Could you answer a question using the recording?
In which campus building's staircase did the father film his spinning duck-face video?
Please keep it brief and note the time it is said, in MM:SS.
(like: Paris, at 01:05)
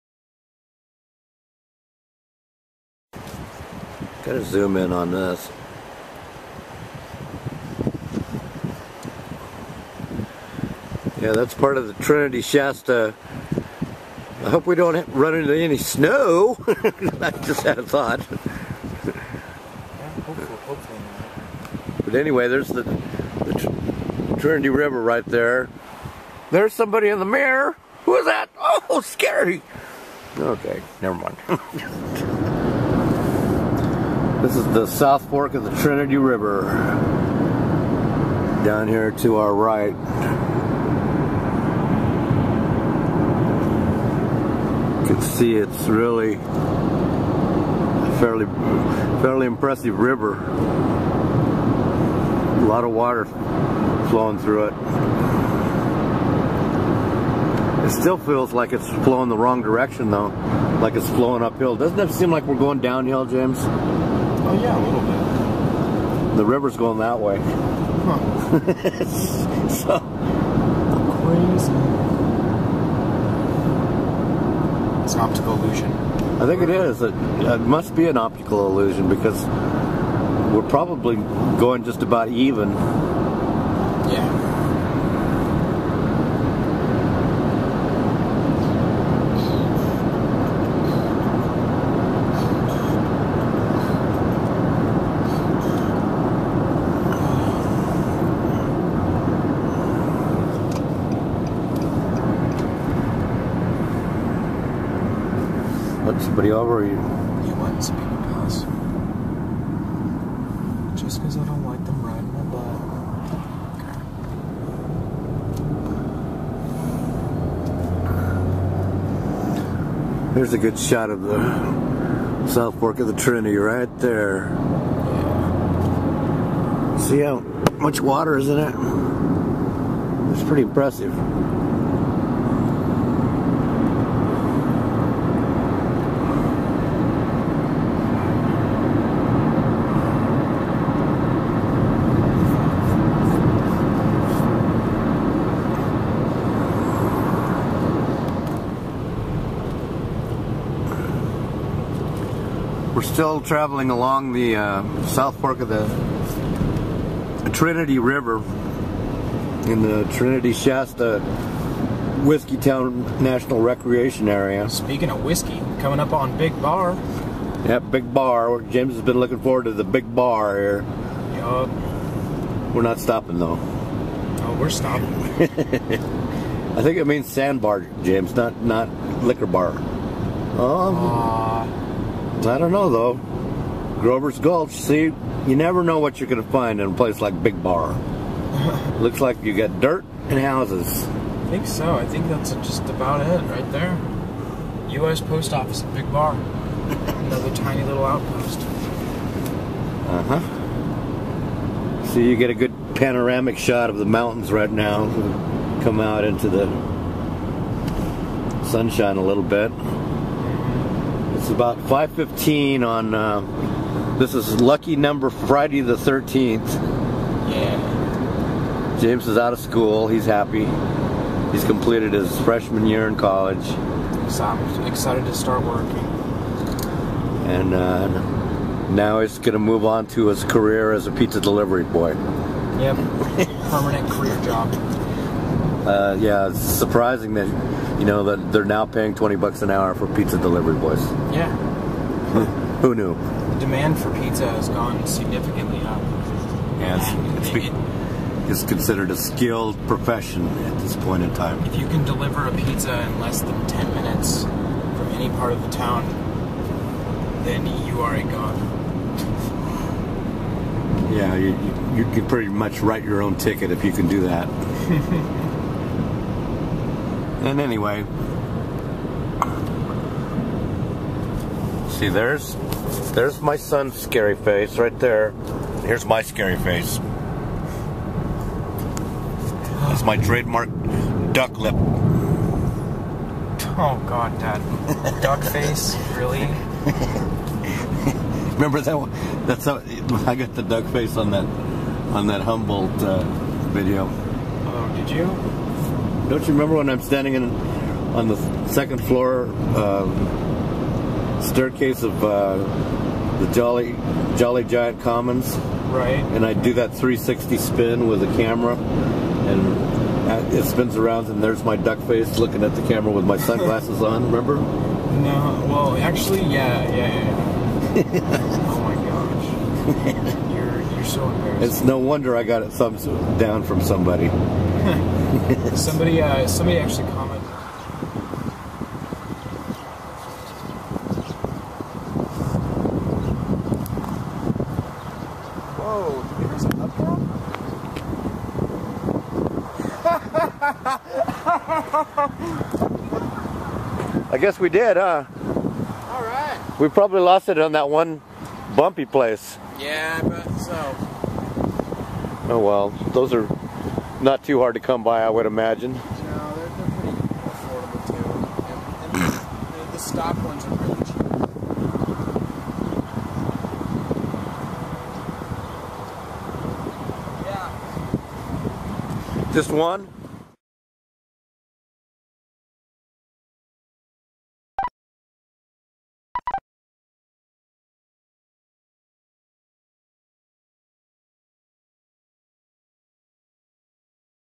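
Jolly Giant Commons, at 05:04.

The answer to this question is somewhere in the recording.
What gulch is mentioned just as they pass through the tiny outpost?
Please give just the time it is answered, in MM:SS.
03:04.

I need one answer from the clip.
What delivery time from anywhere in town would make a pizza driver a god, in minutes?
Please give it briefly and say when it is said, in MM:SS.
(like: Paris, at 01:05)
10, at 04:13.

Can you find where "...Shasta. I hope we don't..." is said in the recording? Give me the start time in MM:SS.
00:12.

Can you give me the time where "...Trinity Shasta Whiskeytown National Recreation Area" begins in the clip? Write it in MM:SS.
02:40.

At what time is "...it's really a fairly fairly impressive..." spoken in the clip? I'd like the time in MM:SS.
00:45.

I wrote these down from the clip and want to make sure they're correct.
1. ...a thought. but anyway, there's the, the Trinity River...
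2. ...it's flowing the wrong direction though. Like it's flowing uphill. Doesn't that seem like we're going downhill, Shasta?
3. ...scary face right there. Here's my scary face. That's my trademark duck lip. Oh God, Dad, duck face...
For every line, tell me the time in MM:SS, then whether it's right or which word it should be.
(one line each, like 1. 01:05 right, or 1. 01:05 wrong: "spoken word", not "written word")
1. 00:17 right
2. 00:58 wrong: "James", not "Shasta"
3. 04:33 right.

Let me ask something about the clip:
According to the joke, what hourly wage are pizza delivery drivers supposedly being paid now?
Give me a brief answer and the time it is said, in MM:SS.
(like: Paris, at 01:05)
$20, at 03:59.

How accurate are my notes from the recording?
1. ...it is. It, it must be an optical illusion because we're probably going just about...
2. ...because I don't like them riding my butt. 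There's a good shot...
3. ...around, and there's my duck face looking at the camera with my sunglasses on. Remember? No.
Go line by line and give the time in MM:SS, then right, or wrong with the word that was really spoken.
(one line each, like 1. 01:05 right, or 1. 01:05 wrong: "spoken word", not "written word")
1. 01:16 right
2. 01:51 right
3. 05:10 right.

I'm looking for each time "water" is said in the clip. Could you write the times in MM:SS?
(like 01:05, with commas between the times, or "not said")
00:52, 02:08.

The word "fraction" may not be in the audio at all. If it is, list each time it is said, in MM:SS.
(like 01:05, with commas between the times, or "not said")
not said.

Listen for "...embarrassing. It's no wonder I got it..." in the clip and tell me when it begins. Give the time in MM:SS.
05:21.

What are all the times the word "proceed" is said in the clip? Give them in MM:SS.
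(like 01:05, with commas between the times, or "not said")
not said.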